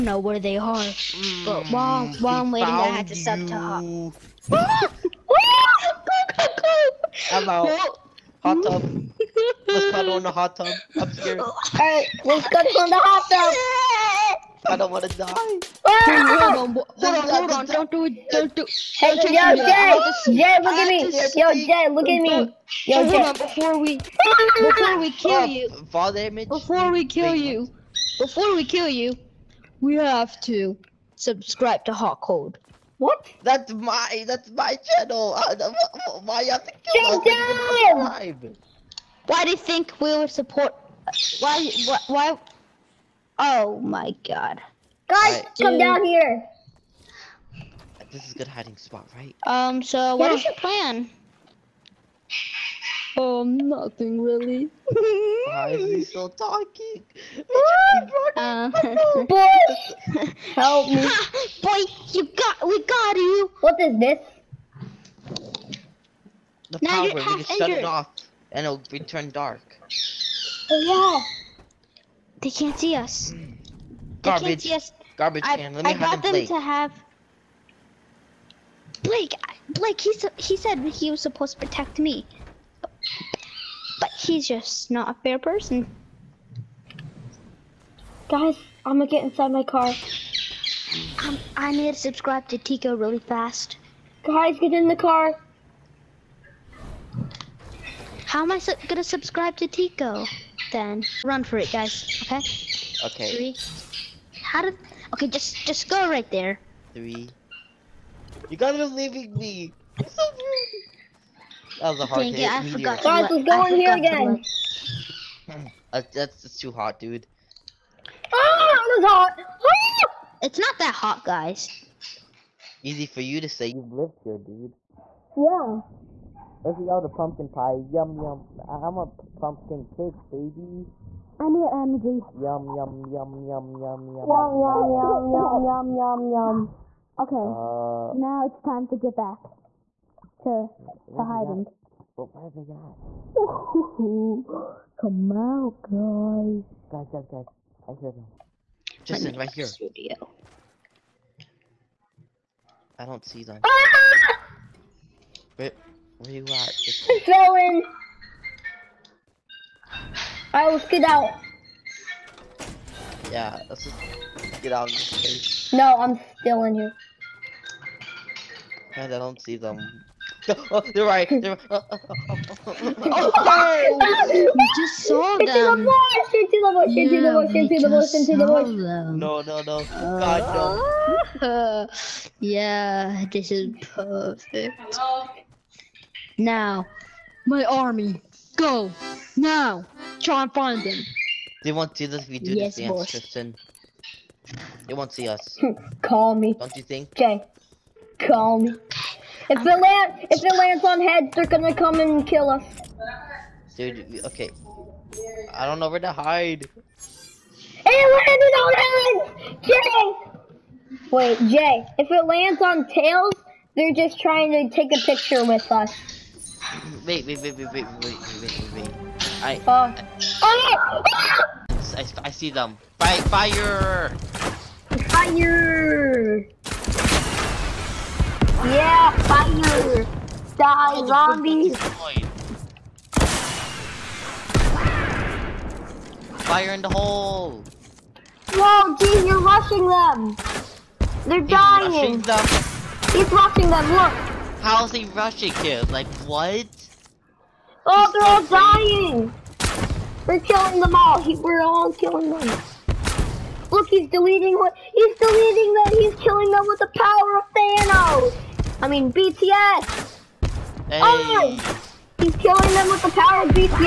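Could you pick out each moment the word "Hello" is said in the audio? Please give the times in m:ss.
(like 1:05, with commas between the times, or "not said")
0:07, 3:04.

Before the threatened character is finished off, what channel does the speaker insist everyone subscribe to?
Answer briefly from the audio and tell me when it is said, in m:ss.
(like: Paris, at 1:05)
Hot Code, at 0:31.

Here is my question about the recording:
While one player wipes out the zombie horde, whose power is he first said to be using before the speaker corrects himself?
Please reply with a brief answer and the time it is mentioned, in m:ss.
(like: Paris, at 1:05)
Thanos, at 4:17.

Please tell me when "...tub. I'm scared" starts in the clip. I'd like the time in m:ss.
0:10.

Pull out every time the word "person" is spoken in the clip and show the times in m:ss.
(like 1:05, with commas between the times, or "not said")
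1:25.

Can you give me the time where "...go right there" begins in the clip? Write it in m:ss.
1:45.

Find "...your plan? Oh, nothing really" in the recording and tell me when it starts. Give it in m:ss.
0:50.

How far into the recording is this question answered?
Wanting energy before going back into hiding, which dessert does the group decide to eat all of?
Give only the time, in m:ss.
2:07.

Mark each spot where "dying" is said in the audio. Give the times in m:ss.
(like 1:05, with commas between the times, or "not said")
4:01, 4:09.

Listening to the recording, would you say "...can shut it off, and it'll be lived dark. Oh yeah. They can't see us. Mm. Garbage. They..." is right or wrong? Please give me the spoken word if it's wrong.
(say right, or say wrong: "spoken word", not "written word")
wrong: "turned", not "lived".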